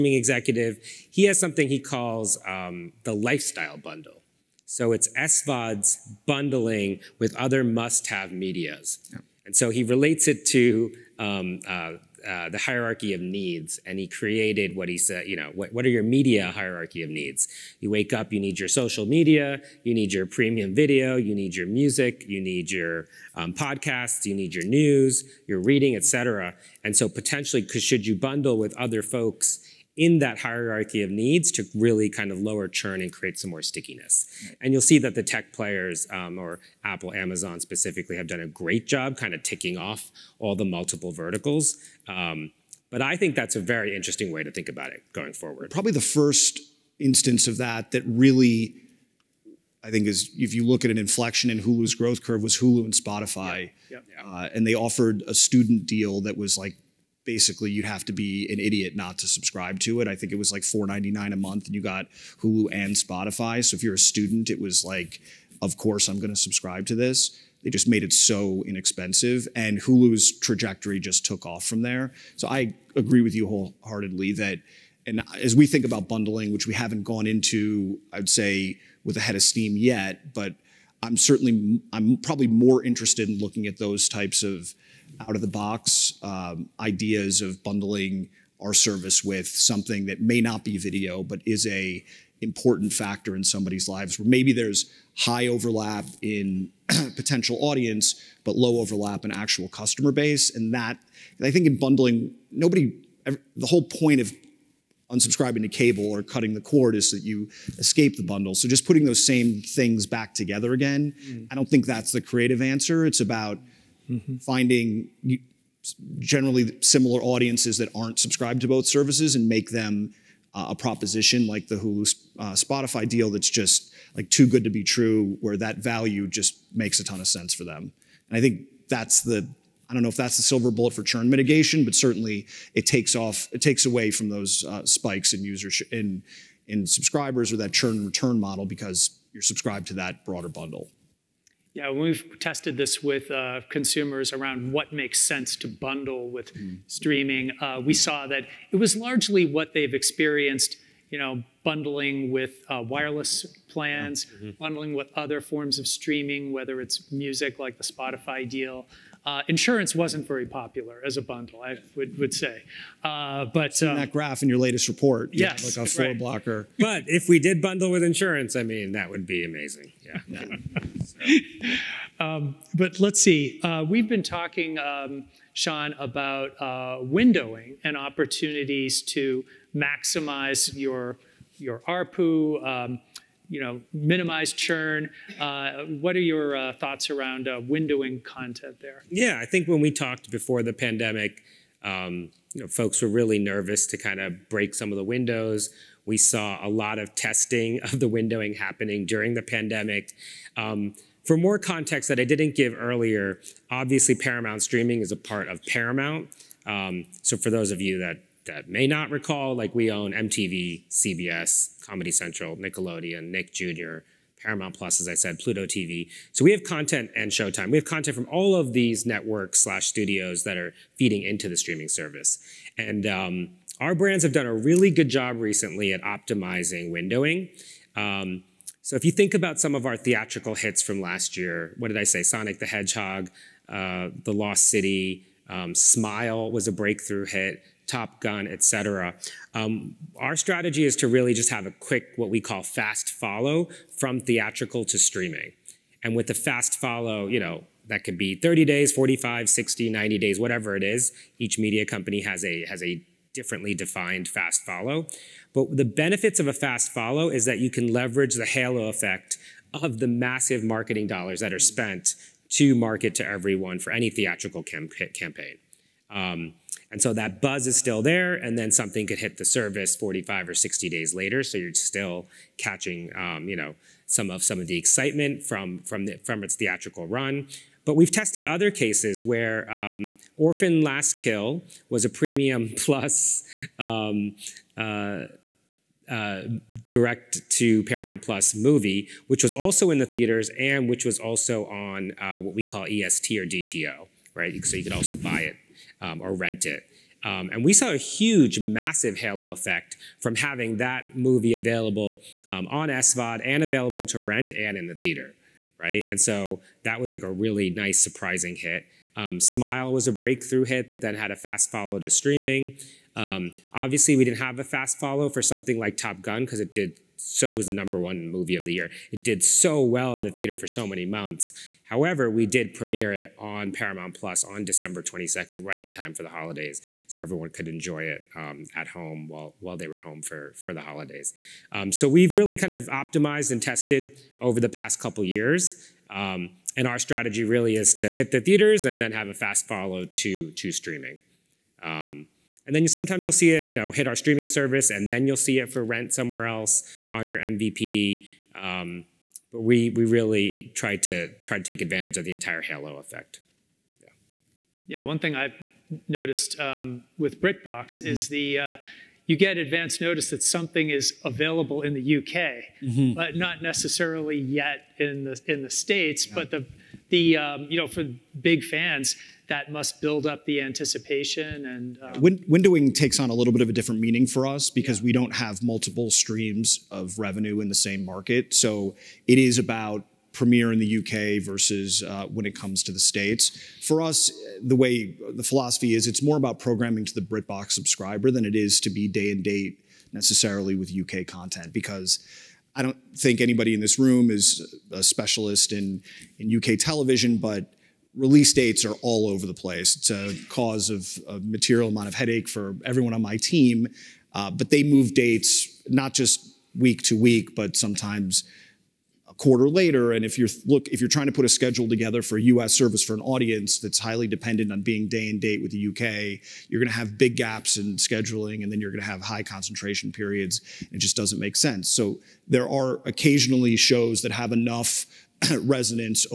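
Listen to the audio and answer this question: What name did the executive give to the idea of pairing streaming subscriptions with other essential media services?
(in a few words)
the lifestyle bundle.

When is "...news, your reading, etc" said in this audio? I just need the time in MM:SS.
00:24.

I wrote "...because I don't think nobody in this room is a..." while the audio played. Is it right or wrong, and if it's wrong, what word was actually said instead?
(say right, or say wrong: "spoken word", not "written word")
wrong: "anybody", not "nobody".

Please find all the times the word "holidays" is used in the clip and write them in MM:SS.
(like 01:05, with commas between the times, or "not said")
05:26, 05:30.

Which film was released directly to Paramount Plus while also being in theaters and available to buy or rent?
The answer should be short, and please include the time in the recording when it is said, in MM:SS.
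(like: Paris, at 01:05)
Orphan Last Kill, at 04:40.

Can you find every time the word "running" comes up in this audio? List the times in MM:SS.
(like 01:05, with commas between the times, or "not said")
not said.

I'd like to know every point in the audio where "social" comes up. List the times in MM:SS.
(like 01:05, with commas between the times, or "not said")
00:18.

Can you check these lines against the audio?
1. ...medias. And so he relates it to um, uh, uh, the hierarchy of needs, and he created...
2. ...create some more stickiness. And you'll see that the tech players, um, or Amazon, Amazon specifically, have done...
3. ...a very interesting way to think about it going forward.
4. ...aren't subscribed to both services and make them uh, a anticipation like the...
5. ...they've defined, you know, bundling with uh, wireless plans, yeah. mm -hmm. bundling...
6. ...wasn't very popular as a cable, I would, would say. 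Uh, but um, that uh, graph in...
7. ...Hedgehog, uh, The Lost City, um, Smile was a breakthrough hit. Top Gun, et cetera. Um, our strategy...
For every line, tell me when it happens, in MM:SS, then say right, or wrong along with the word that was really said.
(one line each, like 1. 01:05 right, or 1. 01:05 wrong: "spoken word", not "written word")
1. 00:08 right
2. 00:33 wrong: "Apple", not "Amazon"
3. 00:43 right
4. 01:57 wrong: "proposition", not "anticipation"
5. 02:29 wrong: "experienced", not "defined"
6. 02:39 wrong: "bundle", not "cable"
7. 03:52 right.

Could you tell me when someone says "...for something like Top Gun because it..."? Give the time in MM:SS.
05:15.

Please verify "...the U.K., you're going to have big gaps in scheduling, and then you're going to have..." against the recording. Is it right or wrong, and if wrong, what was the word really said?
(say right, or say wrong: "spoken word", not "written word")
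right.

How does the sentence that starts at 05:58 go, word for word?
is the uh, you get advance notice that something is available in the UK, mm -hmm.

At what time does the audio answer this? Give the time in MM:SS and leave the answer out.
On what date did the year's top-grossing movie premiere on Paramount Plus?
05:24.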